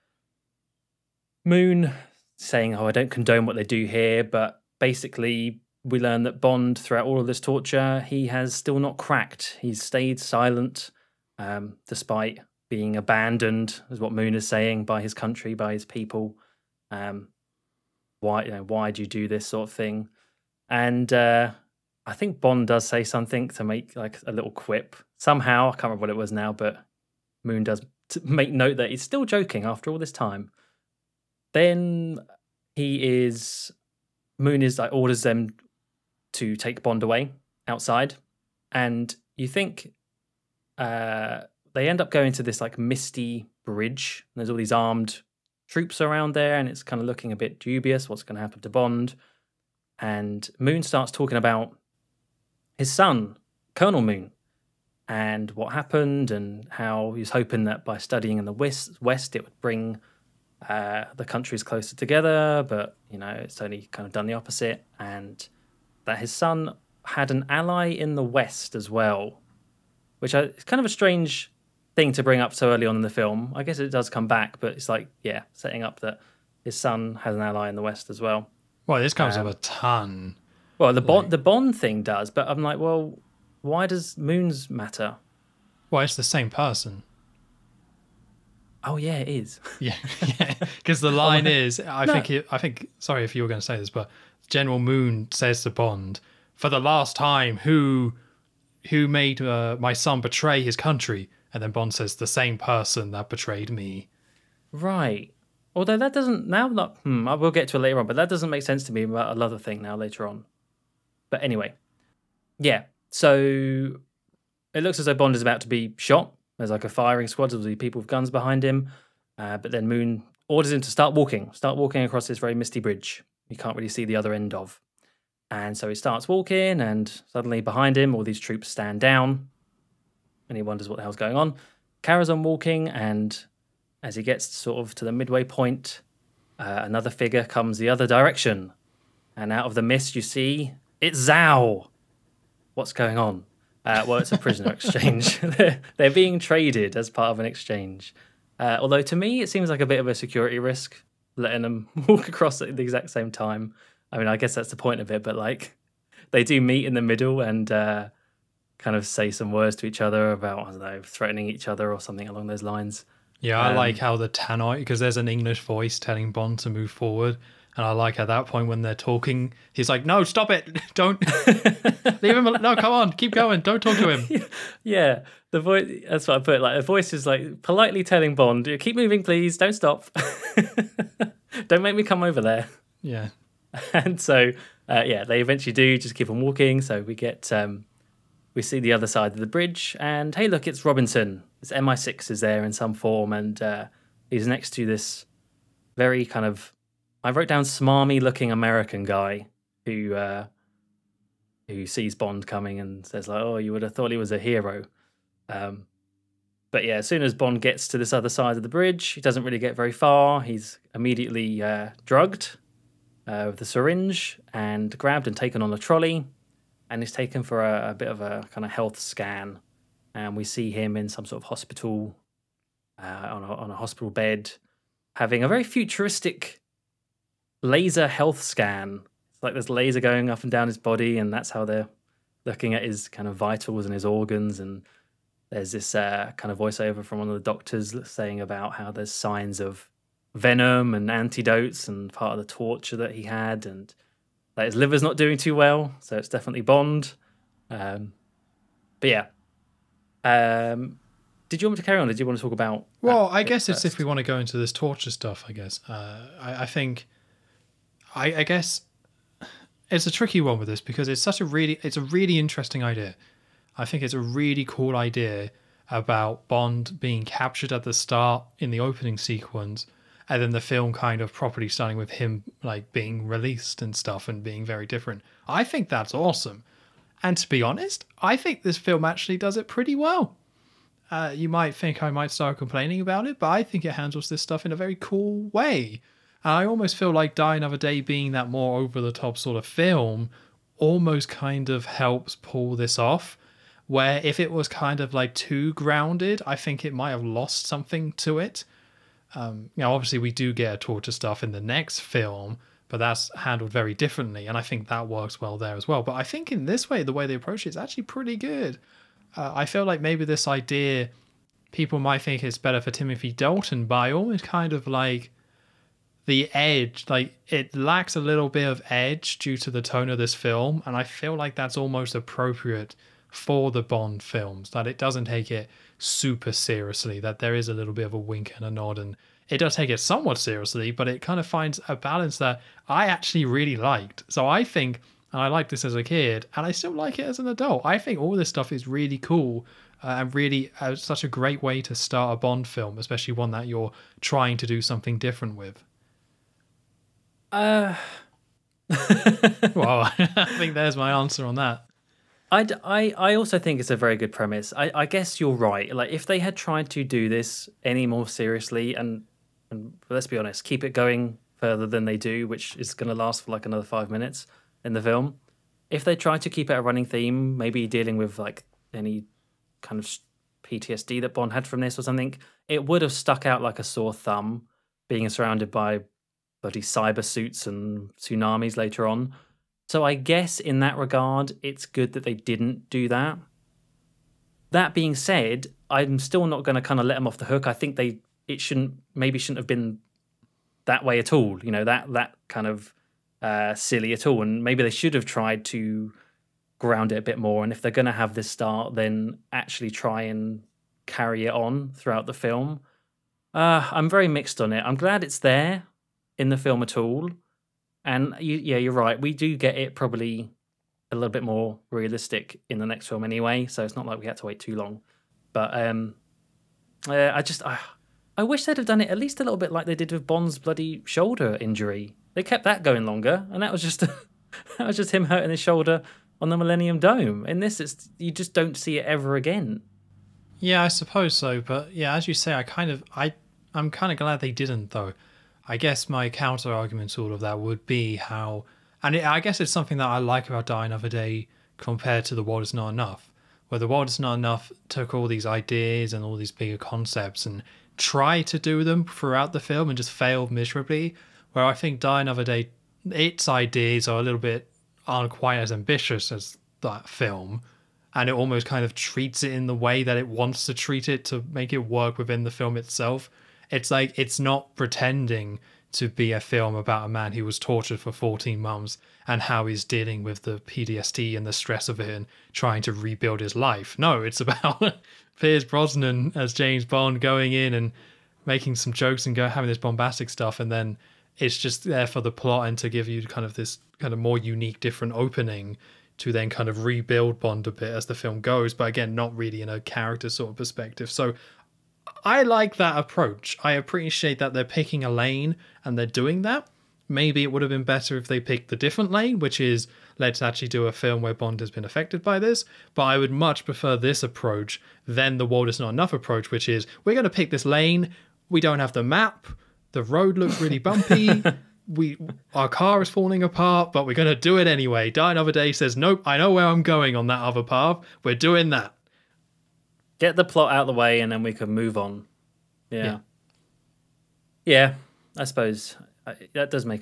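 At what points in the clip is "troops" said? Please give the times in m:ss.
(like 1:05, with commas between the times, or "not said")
0:45, 2:08.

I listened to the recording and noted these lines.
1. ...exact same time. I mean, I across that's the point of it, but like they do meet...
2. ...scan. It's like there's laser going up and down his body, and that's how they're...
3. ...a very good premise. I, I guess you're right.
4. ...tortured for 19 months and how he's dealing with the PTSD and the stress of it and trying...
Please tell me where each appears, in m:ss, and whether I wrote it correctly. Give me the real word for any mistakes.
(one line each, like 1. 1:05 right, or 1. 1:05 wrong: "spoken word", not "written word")
1. 2:32 wrong: "guess", not "across"
2. 3:48 right
3. 5:53 right
4. 7:47 wrong: "14", not "19".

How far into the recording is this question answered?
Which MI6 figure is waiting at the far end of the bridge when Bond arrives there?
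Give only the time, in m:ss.
3:10.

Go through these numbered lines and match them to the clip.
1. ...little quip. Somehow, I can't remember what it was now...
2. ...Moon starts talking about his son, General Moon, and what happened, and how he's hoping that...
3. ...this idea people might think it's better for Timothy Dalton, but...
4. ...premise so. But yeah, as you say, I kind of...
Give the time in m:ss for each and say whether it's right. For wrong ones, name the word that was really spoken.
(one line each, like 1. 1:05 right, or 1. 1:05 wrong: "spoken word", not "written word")
1. 0:24 right
2. 0:50 wrong: "Colonel", not "General"
3. 5:10 right
4. 7:10 wrong: "suppose", not "premise".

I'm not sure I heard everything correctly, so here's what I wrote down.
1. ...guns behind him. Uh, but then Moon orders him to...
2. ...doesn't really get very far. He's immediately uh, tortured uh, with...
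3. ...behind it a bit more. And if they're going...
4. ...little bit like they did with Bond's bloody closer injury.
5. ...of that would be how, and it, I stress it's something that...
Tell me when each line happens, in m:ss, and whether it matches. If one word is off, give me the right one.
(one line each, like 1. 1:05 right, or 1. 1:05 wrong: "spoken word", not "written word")
1. 1:58 right
2. 3:29 wrong: "drugged", not "tortured"
3. 6:36 wrong: "ground", not "behind"
4. 6:59 wrong: "shoulder", not "closer"
5. 7:17 wrong: "guess", not "stress".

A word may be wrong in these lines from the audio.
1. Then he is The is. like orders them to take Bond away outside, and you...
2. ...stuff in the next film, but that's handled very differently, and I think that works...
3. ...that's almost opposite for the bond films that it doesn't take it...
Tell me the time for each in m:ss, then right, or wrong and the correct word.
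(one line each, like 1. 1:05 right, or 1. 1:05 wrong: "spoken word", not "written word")
1. 0:31 wrong: "Moon", not "The"
2. 5:01 right
3. 5:21 wrong: "appropriate", not "opposite".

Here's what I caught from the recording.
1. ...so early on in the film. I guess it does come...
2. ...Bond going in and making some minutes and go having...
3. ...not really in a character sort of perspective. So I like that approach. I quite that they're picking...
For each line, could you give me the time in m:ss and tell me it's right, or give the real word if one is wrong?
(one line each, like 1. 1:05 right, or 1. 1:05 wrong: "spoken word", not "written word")
1. 1:12 right
2. 7:56 wrong: "jokes", not "minutes"
3. 8:09 wrong: "appreciate", not "quite".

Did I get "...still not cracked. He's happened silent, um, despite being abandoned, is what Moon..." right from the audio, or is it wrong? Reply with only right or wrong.
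wrong.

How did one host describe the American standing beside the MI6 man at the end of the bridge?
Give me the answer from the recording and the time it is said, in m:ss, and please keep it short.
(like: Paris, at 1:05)
smarmy looking, at 3:17.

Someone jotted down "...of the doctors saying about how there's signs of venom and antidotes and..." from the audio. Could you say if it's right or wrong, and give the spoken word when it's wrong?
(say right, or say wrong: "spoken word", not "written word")
right.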